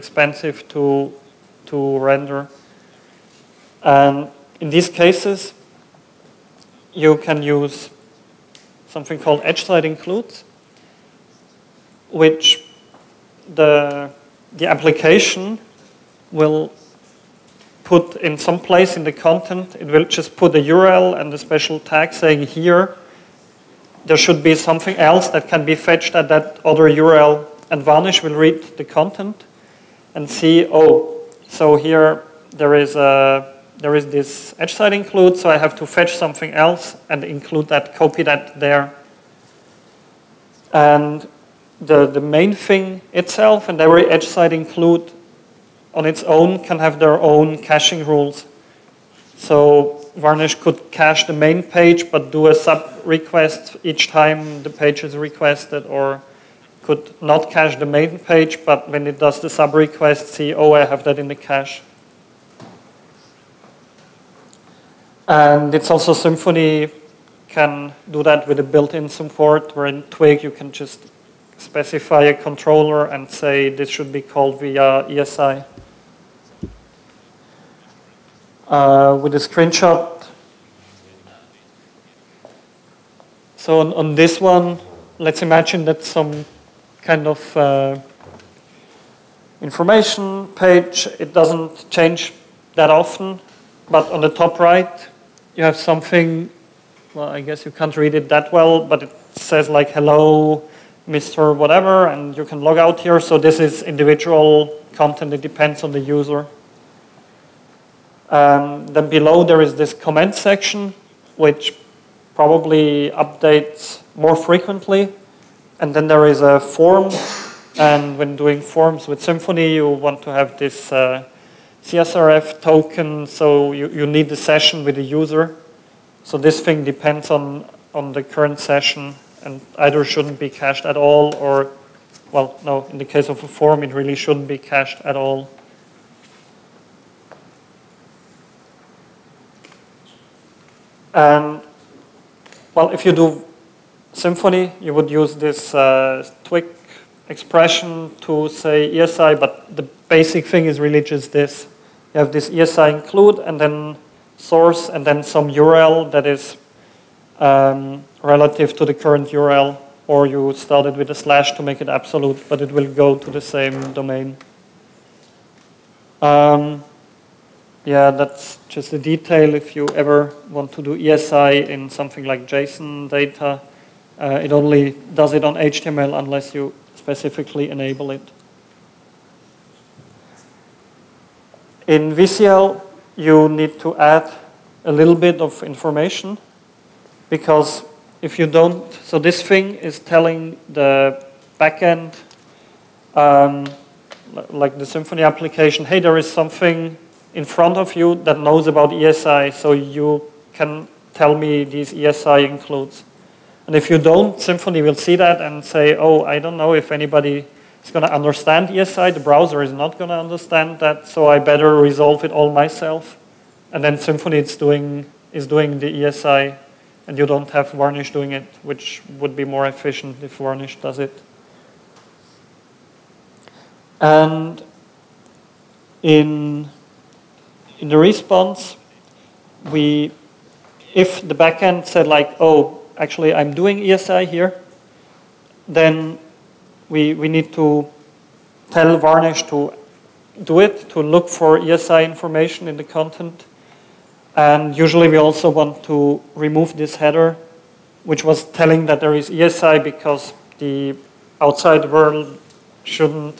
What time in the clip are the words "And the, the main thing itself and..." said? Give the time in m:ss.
0:40.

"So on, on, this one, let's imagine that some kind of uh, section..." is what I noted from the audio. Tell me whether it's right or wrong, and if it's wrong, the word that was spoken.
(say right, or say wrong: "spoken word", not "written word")
wrong: "information", not "section".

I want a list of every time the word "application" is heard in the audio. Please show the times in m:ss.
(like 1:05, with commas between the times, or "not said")
0:14, 3:15.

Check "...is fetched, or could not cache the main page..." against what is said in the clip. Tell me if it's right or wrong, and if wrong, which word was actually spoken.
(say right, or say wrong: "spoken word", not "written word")
wrong: "requested", not "fetched".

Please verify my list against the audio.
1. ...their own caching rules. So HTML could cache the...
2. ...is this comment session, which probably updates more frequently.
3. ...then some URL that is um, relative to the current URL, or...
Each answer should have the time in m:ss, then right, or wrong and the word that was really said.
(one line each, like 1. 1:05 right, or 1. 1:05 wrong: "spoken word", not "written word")
1. 0:46 wrong: "Varnish", not "HTML"
2. 1:49 wrong: "section", not "session"
3. 2:35 right.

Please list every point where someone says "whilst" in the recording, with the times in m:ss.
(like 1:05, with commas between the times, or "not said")
not said.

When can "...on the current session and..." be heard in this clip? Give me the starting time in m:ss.
2:07.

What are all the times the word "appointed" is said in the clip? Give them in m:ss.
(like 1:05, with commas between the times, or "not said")
not said.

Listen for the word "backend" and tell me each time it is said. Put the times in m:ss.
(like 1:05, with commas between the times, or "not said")
3:11, 3:51.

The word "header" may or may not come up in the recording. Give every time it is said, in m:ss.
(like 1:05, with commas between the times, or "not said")
4:06.